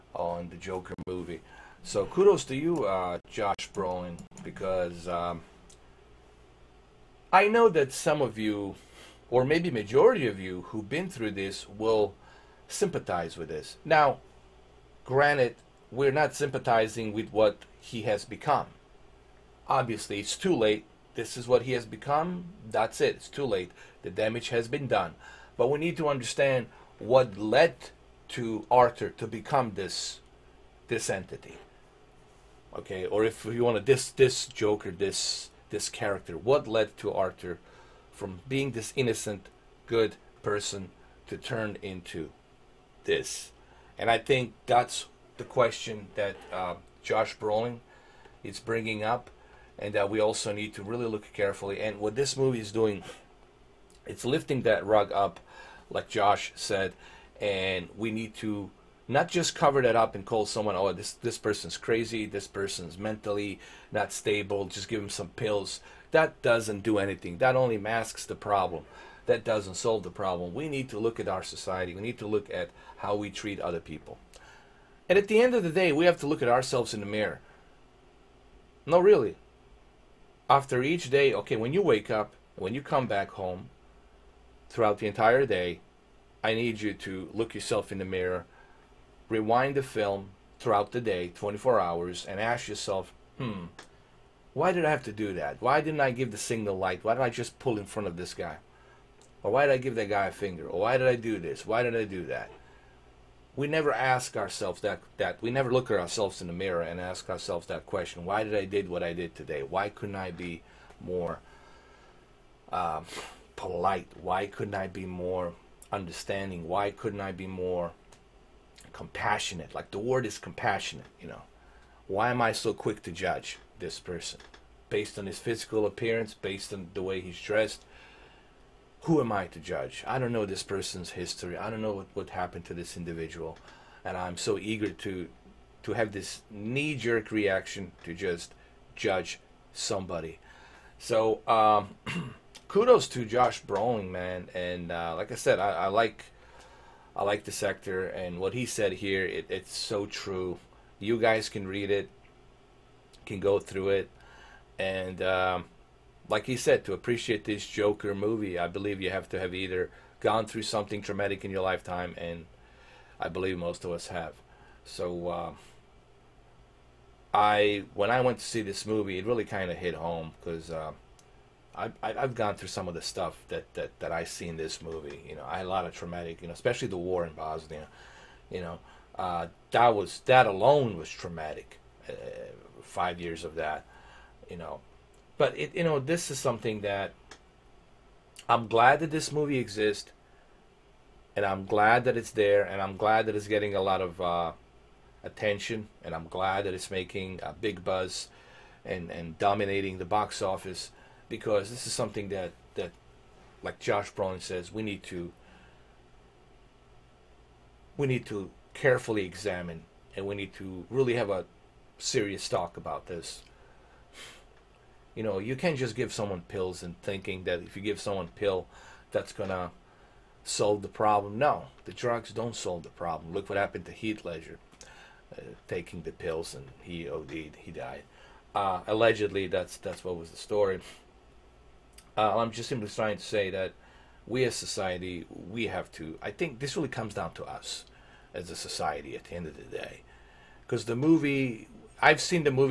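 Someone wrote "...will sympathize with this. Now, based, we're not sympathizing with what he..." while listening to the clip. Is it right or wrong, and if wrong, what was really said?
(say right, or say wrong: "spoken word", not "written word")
wrong: "granted", not "based".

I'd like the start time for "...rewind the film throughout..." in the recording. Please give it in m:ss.
1:29.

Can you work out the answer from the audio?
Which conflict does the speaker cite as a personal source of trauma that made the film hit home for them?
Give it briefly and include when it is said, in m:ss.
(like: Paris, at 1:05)
the war in Bosnia, at 2:56.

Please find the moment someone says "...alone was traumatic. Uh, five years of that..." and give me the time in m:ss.
3:00.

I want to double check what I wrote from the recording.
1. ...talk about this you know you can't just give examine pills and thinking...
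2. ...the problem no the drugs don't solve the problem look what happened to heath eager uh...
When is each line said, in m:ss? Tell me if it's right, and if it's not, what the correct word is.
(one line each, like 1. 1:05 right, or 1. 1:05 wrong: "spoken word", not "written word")
1. 3:32 wrong: "someone", not "examine"
2. 3:40 wrong: "ledger", not "eager".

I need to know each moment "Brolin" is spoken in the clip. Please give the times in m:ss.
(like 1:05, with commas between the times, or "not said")
0:03, 0:47, 2:23, 3:24.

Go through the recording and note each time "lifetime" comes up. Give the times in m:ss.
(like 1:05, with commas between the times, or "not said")
2:41.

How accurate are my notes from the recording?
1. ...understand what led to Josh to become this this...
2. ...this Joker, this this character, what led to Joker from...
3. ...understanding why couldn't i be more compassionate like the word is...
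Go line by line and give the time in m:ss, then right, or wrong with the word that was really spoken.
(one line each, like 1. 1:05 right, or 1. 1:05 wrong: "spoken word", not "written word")
1. 0:26 wrong: "Arthur", not "Josh"
2. 0:34 wrong: "Arthur", not "Joker"
3. 1:55 right.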